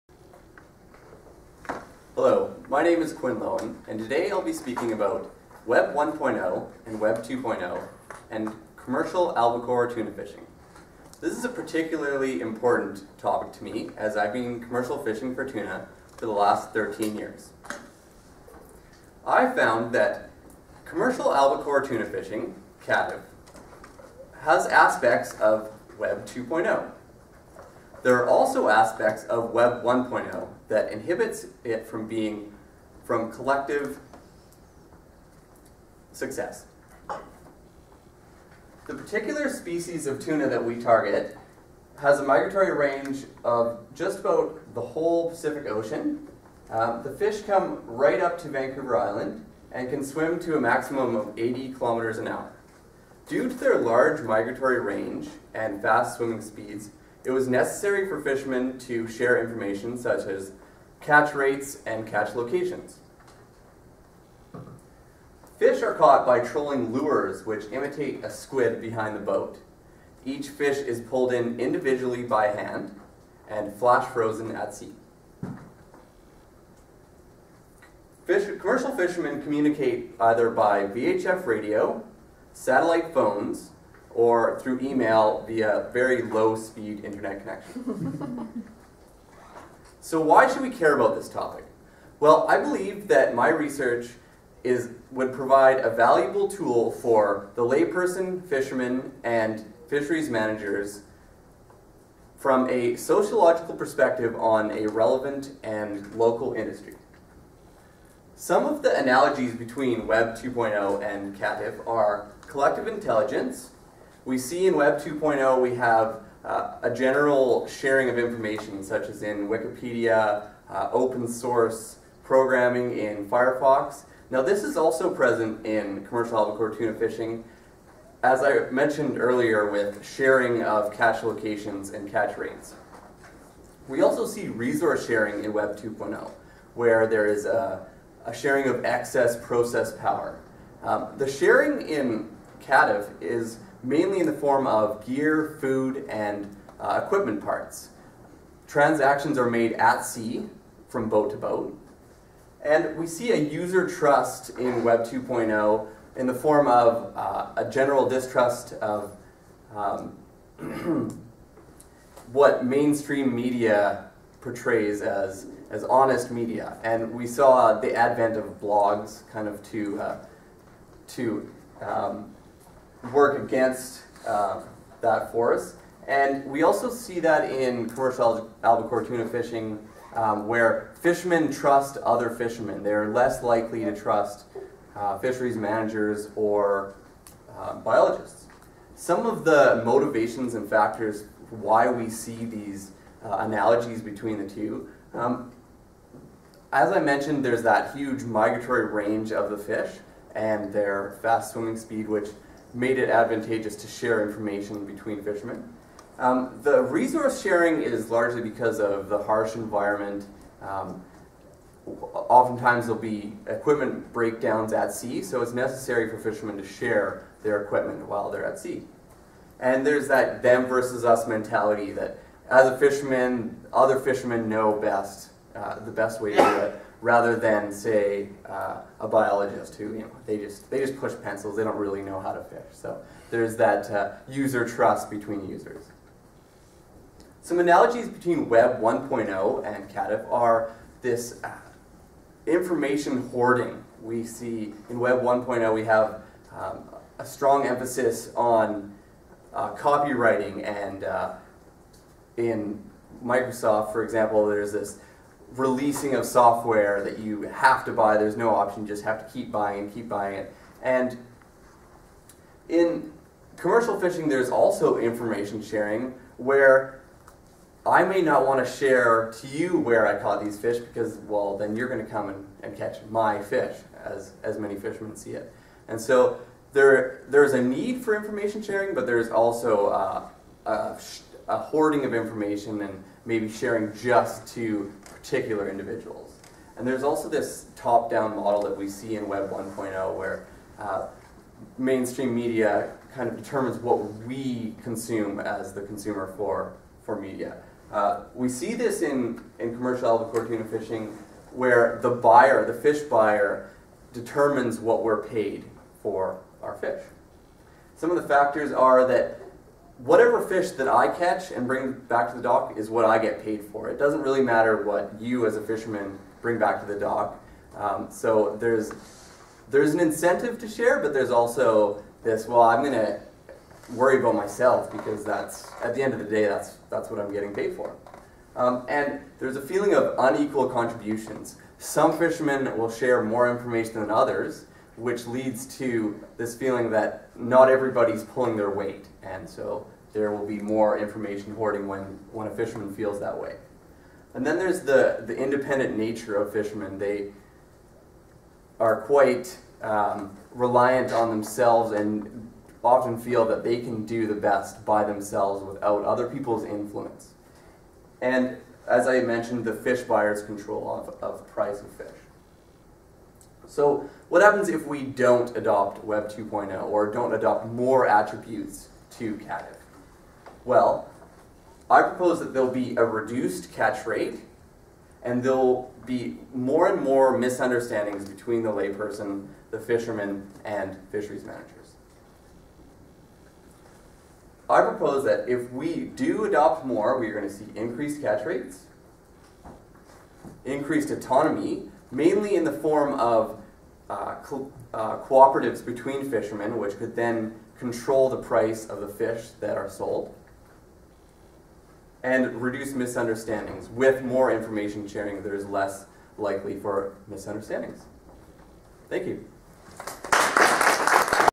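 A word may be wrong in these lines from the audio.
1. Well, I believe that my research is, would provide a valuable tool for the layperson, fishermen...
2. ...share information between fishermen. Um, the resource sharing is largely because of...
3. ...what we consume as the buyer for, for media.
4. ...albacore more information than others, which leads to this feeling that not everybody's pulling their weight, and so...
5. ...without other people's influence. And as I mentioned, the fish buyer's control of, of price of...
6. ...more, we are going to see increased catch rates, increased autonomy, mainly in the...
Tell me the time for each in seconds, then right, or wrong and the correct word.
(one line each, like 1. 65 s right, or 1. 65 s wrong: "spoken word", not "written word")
1. 92 s right
2. 203 s right
3. 293 s wrong: "consumer", not "buyer"
4. 332 s wrong: "share", not "albacore"
5. 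355 s right
6. 386 s right.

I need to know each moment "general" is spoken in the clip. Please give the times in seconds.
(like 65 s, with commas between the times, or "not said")
116 s, 157 s.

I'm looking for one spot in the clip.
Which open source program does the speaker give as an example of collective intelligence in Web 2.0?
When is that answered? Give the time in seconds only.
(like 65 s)
123 s.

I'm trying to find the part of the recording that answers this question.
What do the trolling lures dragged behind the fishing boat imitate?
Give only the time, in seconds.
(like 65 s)
68 s.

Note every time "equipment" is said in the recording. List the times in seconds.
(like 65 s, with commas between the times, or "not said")
147 s, 213 s, 217 s.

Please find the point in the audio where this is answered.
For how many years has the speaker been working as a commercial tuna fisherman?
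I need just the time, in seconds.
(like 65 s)
16 s.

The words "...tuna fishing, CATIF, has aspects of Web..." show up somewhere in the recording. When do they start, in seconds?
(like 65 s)
21 s.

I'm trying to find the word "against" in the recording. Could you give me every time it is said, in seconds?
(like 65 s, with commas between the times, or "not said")
173 s.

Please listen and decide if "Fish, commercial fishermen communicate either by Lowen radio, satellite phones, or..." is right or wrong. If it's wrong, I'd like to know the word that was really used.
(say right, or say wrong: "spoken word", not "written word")
wrong: "VHF", not "Lowen".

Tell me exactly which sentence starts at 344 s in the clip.
And then there's the, the independent nature of fishermen.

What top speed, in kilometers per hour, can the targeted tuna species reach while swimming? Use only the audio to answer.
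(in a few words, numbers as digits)
80 kilometers an hour.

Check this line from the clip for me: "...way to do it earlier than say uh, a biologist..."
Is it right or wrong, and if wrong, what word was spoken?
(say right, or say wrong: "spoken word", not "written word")
wrong: "rather", not "earlier".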